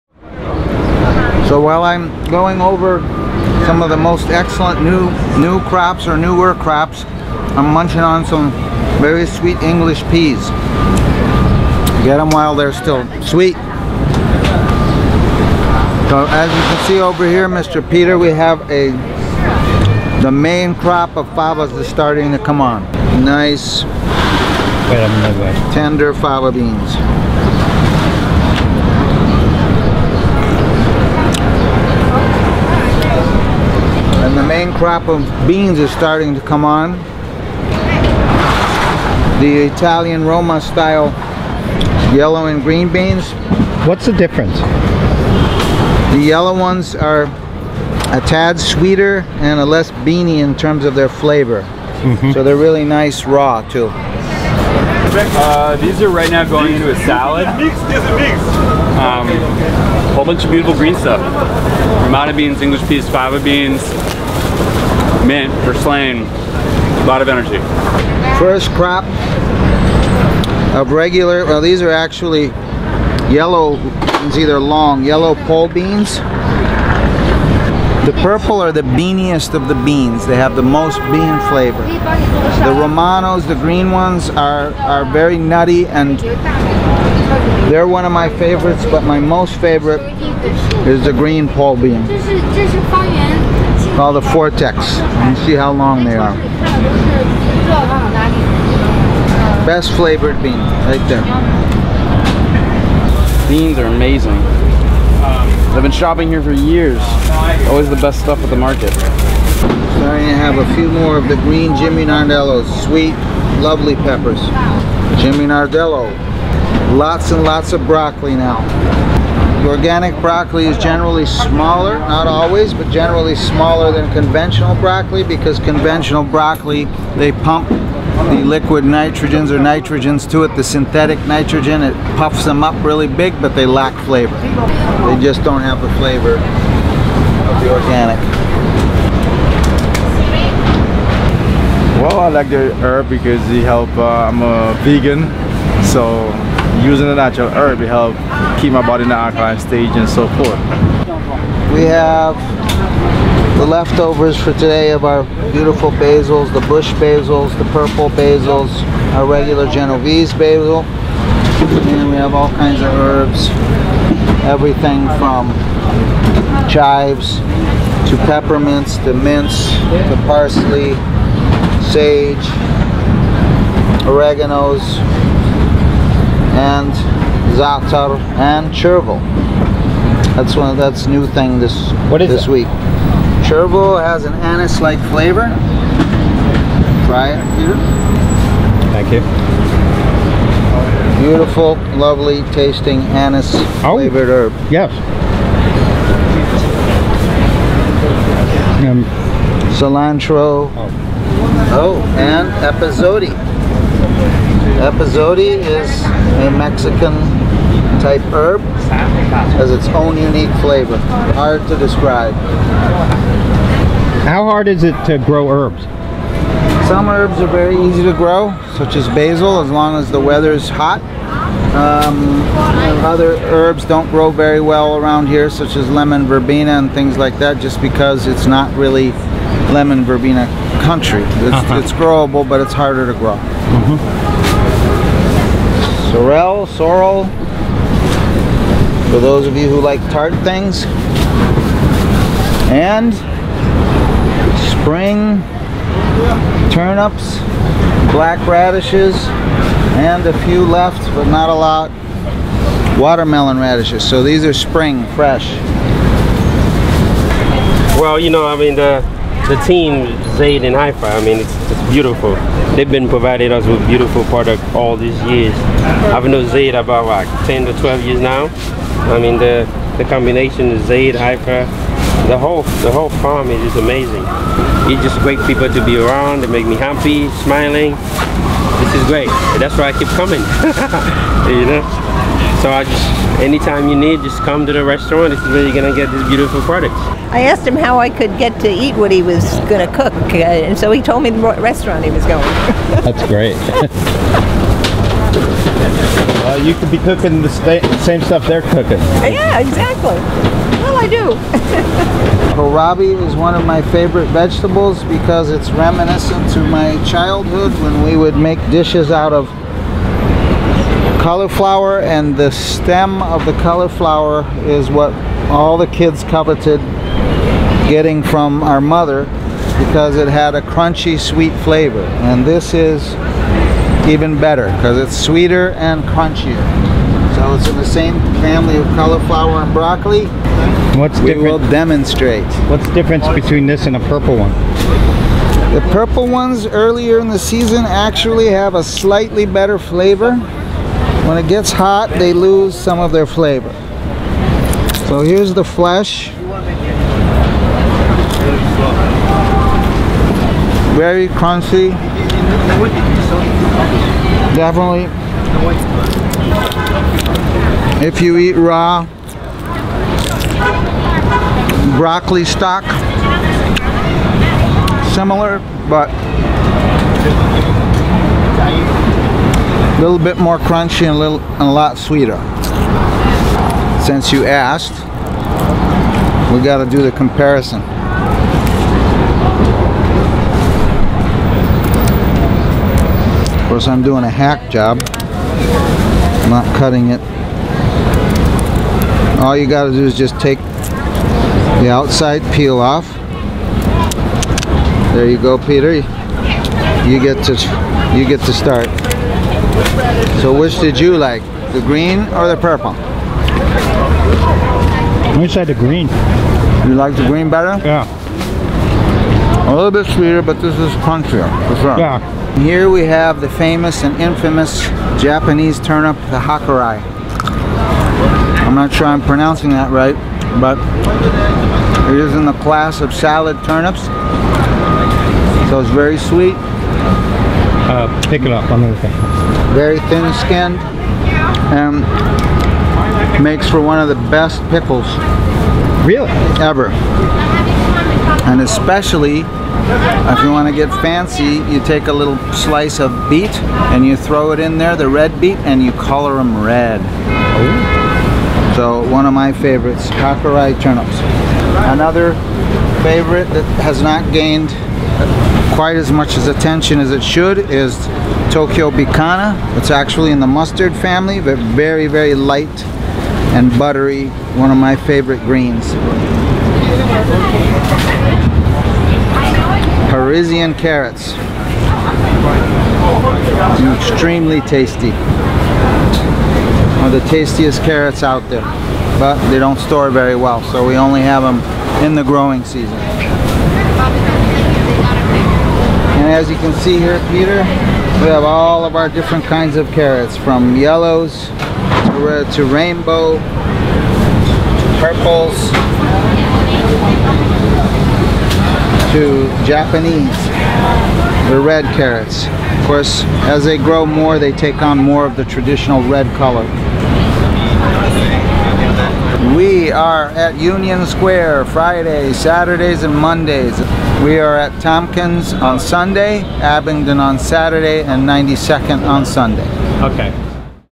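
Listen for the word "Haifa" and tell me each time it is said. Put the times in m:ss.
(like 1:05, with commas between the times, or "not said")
4:20, 4:31.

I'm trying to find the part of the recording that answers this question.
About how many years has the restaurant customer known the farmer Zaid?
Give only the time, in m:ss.
4:27.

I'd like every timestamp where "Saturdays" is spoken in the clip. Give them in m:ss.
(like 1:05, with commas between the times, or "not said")
8:32, 8:37.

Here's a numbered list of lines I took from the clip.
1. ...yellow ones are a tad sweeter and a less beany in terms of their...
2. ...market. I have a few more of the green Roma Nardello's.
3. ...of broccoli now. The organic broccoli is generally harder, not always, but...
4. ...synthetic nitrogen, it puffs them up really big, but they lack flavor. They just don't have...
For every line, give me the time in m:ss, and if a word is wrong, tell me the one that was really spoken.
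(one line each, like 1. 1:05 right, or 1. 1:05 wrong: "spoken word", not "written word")
1. 0:46 right
2. 1:48 wrong: "Jimmy", not "Roma"
3. 1:57 wrong: "smaller", not "harder"
4. 2:10 right.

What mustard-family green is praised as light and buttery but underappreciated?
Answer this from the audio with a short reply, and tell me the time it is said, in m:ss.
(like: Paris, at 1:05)
Tokyo Bekana, at 7:38.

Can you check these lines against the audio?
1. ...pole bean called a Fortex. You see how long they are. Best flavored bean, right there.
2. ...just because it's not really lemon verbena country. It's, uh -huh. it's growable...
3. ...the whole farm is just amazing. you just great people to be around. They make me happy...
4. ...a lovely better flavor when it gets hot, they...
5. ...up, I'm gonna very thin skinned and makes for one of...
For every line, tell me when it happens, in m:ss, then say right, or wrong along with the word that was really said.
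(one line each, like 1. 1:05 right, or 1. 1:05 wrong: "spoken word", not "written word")
1. 1:31 right
2. 3:47 right
3. 4:32 right
4. 5:38 wrong: "slightly", not "lovely"
5. 7:08 right.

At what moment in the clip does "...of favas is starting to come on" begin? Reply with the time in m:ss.
0:21.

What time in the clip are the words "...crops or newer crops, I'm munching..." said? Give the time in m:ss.
0:05.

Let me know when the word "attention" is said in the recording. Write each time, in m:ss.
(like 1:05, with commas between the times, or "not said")
7:36.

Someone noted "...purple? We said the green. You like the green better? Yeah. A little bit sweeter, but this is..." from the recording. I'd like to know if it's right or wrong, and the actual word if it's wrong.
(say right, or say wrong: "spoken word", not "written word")
right.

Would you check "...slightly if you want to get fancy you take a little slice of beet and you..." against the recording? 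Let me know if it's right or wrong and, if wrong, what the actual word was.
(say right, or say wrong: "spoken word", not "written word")
wrong: "especially", not "slightly".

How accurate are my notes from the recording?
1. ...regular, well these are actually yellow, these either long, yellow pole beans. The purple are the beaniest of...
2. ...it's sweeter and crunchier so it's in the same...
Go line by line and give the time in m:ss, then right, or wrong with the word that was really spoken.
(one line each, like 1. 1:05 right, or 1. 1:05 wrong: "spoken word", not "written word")
1. 1:10 right
2. 5:24 right.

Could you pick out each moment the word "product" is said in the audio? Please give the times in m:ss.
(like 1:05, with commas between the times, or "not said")
4:24, 4:46.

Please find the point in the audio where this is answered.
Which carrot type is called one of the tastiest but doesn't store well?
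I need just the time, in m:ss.
7:50.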